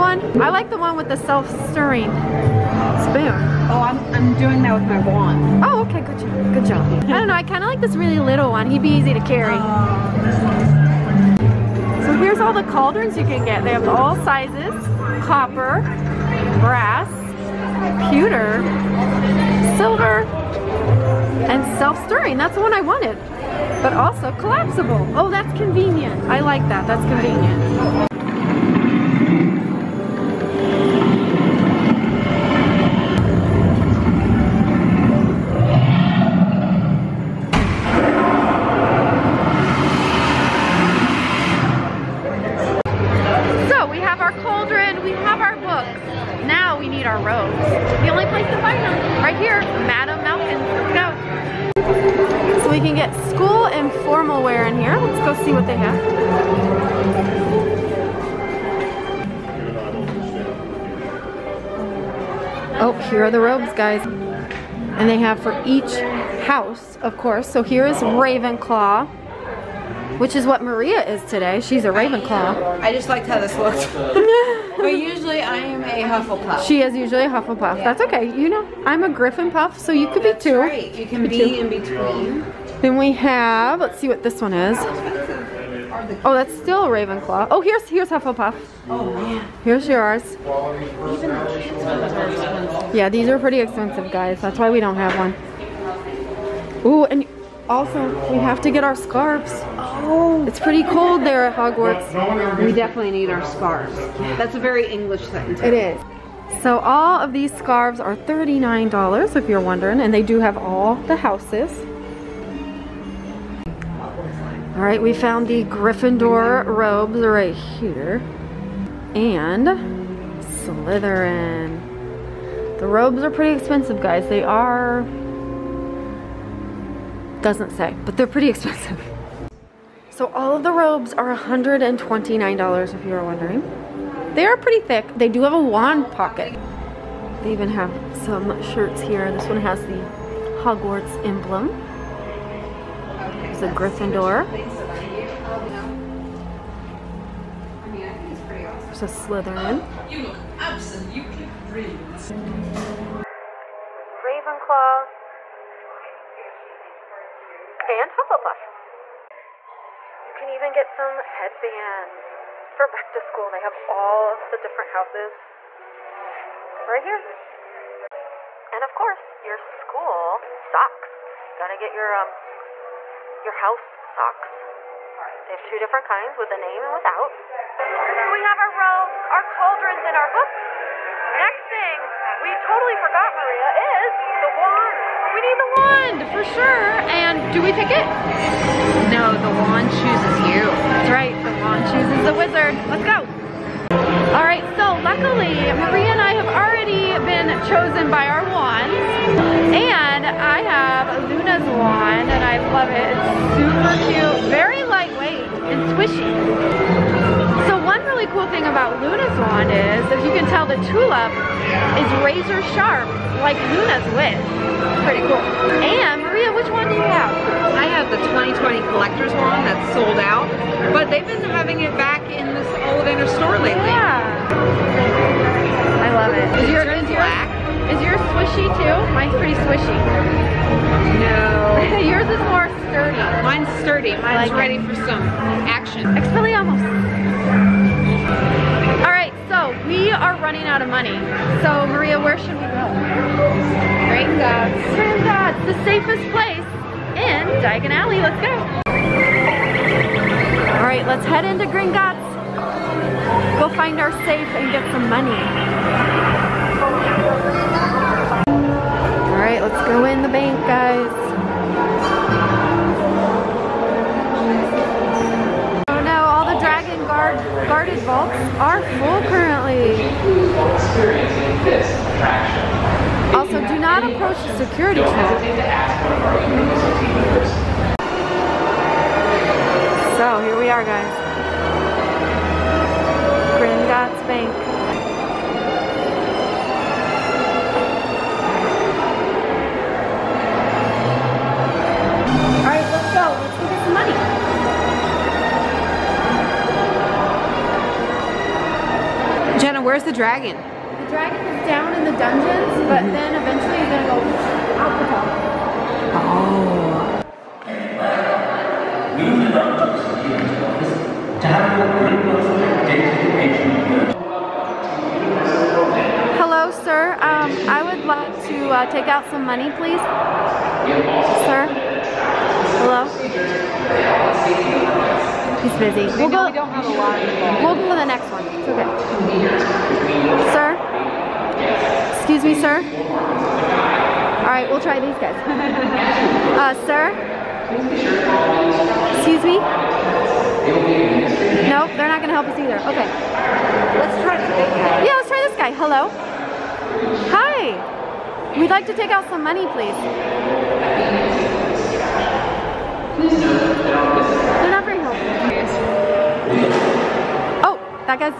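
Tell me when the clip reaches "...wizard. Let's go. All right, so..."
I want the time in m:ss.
3:12.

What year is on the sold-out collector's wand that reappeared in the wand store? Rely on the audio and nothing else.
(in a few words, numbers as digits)
2020.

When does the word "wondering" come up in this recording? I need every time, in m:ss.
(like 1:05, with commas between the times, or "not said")
1:49, 2:13.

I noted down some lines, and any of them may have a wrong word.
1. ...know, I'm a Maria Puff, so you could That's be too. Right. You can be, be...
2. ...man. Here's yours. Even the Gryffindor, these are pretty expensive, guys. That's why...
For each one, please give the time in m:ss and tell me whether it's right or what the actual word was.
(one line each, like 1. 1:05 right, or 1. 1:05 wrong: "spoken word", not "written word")
1. 1:18 wrong: "Griffin", not "Maria"
2. 1:29 wrong: "Yeah", not "Gryffindor".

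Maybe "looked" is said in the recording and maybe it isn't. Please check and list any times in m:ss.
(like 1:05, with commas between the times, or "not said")
1:13.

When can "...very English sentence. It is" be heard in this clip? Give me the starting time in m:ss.
1:44.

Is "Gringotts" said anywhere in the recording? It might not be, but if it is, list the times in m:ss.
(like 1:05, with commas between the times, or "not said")
4:04, 4:11, 4:43.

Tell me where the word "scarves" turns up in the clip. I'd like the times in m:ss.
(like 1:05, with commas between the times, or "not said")
1:38, 1:43, 1:47.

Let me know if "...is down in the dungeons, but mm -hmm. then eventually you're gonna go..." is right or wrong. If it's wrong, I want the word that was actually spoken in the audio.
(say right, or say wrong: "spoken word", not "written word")
right.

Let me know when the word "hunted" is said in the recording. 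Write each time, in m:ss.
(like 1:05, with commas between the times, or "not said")
not said.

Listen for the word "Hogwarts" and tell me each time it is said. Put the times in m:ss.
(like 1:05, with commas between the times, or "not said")
1:41, 2:20.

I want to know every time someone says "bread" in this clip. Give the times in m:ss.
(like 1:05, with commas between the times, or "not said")
not said.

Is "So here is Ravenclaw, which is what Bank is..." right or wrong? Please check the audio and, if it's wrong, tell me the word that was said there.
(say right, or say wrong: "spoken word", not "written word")
wrong: "Maria", not "Bank".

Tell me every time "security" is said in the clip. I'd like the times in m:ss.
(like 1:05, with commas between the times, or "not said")
4:34.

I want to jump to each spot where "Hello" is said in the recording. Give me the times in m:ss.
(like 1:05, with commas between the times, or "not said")
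5:16, 5:22, 5:45.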